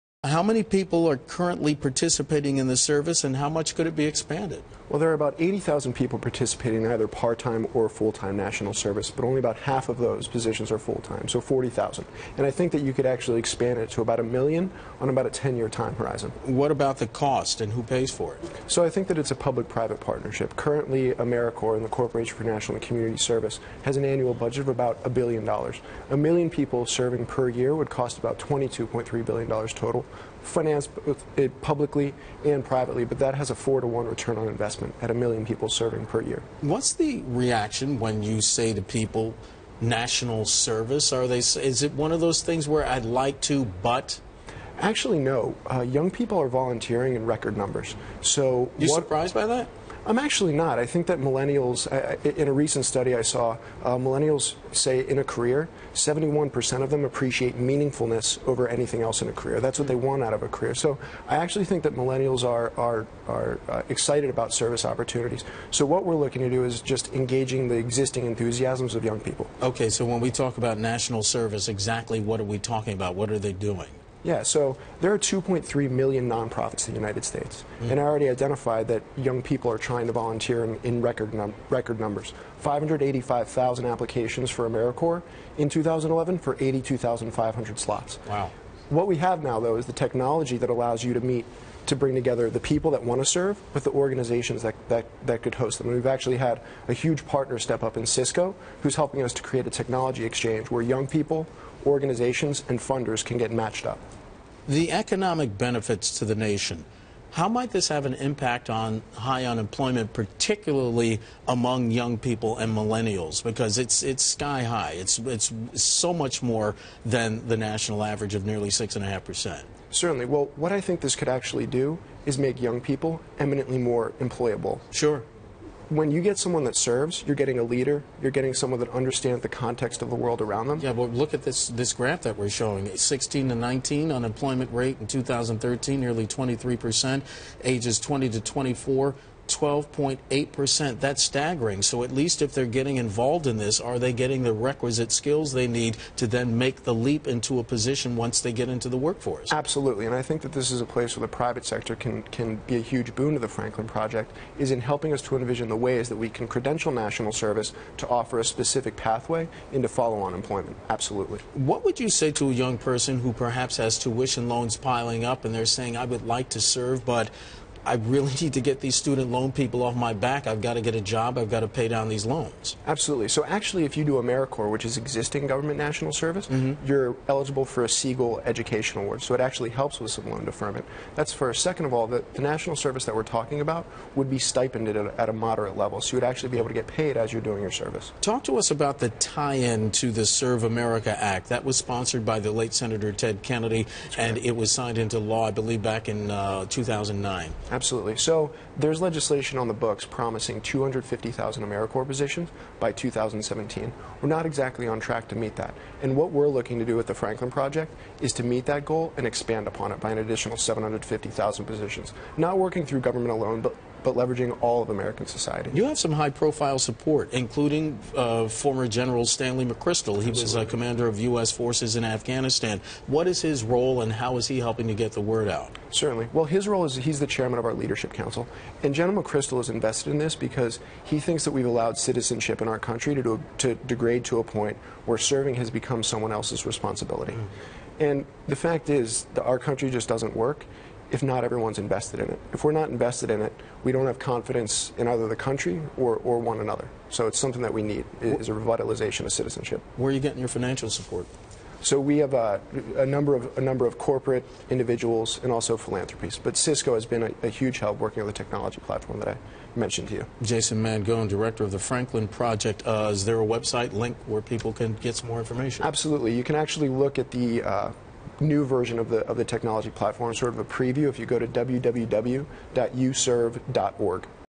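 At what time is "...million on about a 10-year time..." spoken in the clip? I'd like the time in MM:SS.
00:14.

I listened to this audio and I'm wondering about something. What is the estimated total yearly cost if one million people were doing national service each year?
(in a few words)
$22.3 billion.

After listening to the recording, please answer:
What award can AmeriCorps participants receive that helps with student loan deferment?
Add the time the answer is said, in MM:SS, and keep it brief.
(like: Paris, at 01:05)
Segal Education Award, at 02:57.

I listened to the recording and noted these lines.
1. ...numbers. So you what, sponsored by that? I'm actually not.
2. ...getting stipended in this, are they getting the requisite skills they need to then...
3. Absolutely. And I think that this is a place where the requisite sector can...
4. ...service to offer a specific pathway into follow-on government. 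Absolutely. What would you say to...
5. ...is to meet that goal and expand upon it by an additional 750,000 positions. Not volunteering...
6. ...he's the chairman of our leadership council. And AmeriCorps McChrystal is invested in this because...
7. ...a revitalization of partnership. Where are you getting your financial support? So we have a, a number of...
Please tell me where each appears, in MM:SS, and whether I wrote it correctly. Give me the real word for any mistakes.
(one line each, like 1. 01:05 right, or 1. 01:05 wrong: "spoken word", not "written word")
1. 00:47 wrong: "surprised", not "sponsored"
2. 02:22 wrong: "involved", not "stipended"
3. 02:29 wrong: "private", not "requisite"
4. 02:37 wrong: "employment", not "government"
5. 03:28 wrong: "working", not "volunteering"
6. 03:46 wrong: "General", not "AmeriCorps"
7. 04:08 wrong: "citizenship", not "partnership".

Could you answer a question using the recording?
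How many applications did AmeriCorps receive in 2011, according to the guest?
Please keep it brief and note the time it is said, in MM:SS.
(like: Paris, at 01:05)
585,000, at 01:22.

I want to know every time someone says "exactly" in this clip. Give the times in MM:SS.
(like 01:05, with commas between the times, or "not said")
01:11, 03:24.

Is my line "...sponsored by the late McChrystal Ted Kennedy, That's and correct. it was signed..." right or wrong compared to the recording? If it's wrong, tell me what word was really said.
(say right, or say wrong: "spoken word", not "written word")
wrong: "Senator", not "McChrystal".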